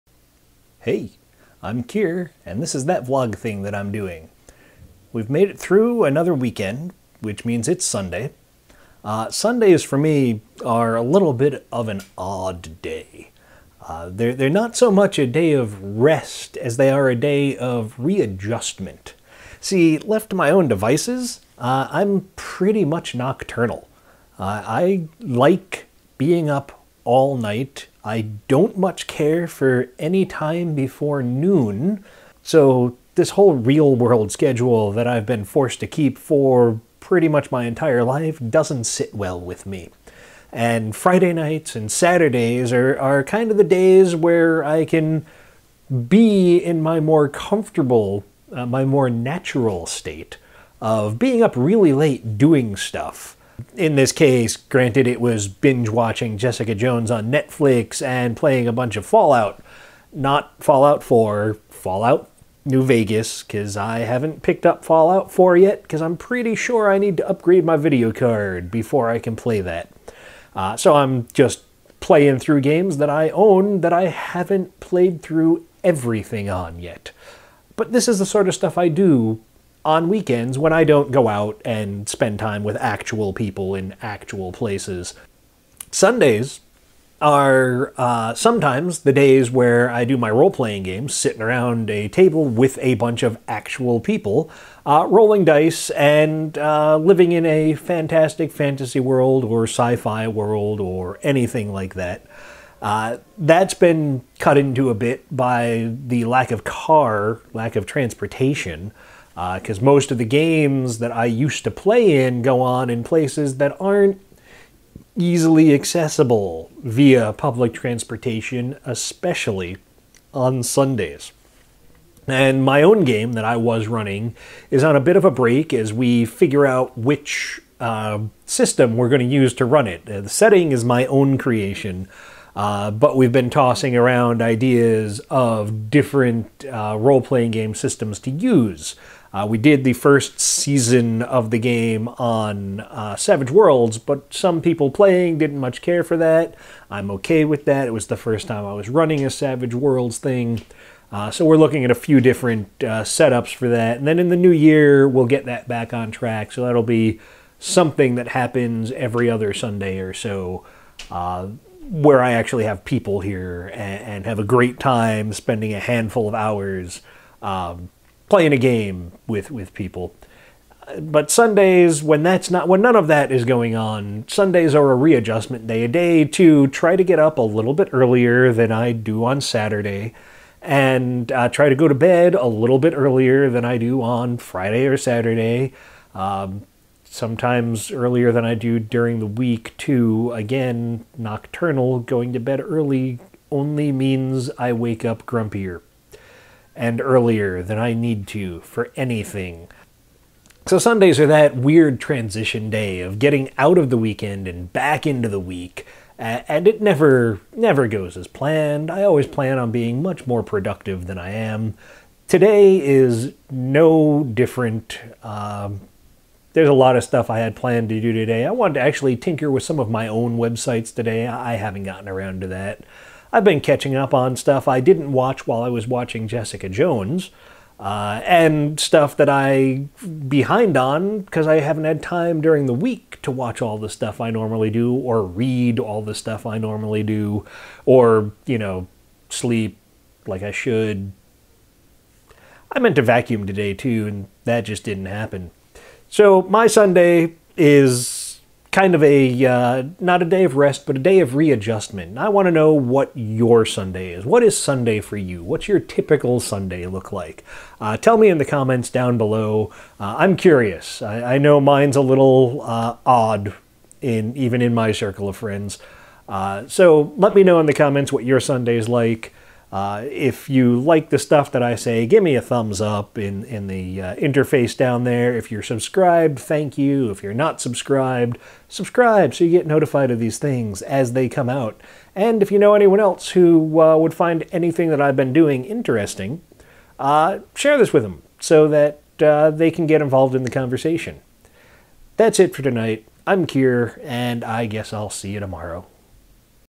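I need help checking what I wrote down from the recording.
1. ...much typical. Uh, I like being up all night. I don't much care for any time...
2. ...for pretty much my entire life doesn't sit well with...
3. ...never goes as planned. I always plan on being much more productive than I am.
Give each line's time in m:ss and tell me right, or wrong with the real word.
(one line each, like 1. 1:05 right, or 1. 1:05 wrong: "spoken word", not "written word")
1. 0:22 wrong: "nocturnal", not "typical"
2. 0:36 right
3. 3:27 right.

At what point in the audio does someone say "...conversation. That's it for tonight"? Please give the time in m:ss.
4:50.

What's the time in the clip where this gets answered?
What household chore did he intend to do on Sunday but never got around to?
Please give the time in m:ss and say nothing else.
4:03.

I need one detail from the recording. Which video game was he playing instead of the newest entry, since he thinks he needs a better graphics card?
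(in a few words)
Fallout New Vegas.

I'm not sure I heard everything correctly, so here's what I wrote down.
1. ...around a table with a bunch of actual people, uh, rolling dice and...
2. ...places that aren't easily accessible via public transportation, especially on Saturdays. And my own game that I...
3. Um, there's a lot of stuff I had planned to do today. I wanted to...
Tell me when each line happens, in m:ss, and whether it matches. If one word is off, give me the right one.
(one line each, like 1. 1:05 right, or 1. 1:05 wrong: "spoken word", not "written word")
1. 1:31 right
2. 1:53 wrong: "Sundays", not "Saturdays"
3. 3:35 right.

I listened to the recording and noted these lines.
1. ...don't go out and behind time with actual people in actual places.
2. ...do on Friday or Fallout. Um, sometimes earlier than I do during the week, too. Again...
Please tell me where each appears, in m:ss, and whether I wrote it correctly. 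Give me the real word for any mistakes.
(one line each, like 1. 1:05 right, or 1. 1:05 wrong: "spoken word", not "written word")
1. 1:20 wrong: "spend", not "behind"
2. 3:03 wrong: "Saturday", not "Fallout".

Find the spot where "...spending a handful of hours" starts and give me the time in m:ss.
2:45.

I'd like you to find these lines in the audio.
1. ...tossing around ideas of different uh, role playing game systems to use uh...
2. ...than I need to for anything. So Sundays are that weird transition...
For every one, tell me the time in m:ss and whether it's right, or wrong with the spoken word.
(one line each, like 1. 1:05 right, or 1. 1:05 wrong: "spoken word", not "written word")
1. 2:13 right
2. 3:17 right.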